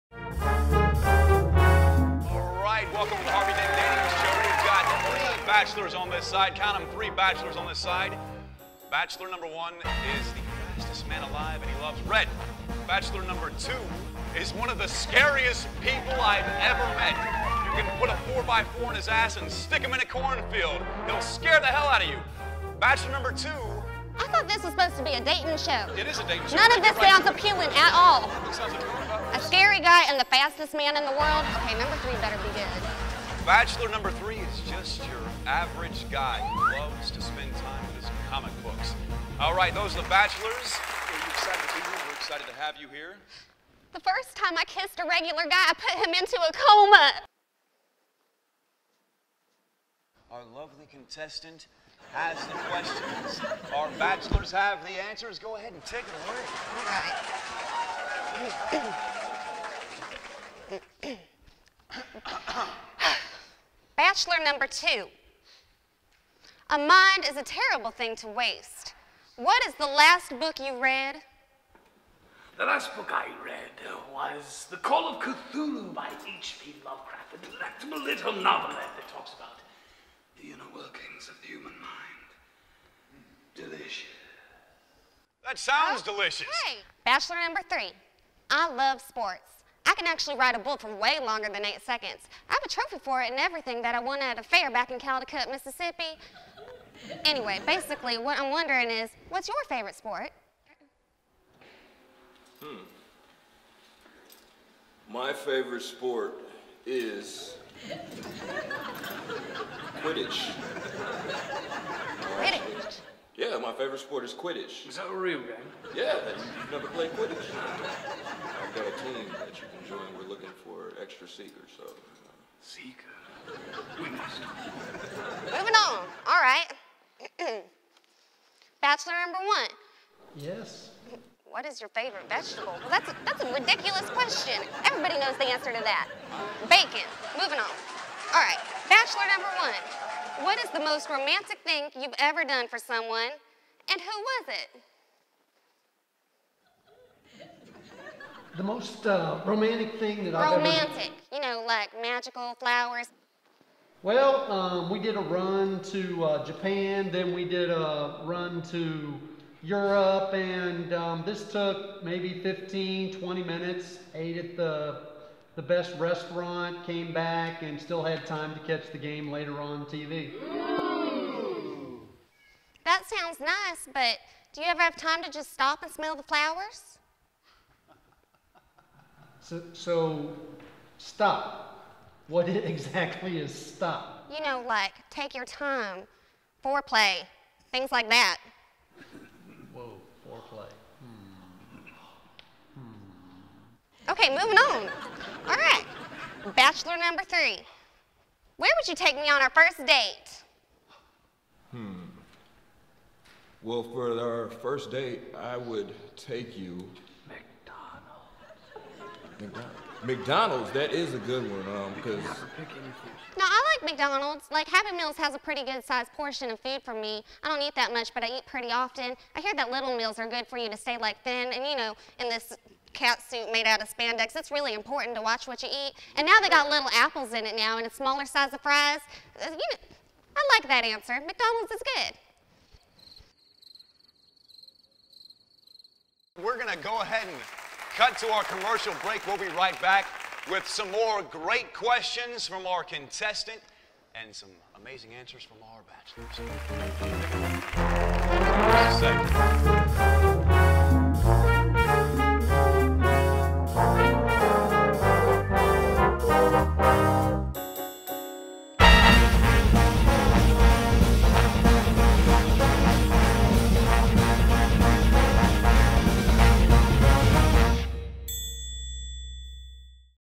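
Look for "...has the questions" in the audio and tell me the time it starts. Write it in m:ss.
0:52.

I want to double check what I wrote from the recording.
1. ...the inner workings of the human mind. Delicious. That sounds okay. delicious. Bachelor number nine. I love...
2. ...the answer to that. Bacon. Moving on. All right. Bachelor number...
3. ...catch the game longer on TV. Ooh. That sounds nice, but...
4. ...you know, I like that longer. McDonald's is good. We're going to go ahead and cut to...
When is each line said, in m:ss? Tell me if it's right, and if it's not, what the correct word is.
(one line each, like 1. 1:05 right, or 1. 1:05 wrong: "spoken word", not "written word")
1. 1:20 wrong: "three", not "nine"
2. 2:15 right
3. 2:48 wrong: "later", not "longer"
4. 3:49 wrong: "answer", not "longer".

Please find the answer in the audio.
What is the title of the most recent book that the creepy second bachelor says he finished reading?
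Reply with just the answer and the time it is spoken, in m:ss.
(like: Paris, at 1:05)
The Call of Cthulhu, at 1:14.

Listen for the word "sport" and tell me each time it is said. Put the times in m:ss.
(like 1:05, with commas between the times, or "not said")
1:28, 1:39, 1:45, 1:53.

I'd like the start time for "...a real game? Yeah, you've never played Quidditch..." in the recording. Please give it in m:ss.
1:55.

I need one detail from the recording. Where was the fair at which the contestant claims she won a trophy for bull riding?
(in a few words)
Caldecott, Mississippi.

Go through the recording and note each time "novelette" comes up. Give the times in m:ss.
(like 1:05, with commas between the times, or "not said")
1:18.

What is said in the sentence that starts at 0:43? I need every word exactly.
The first time I kissed a regular guy, I put him into a coma.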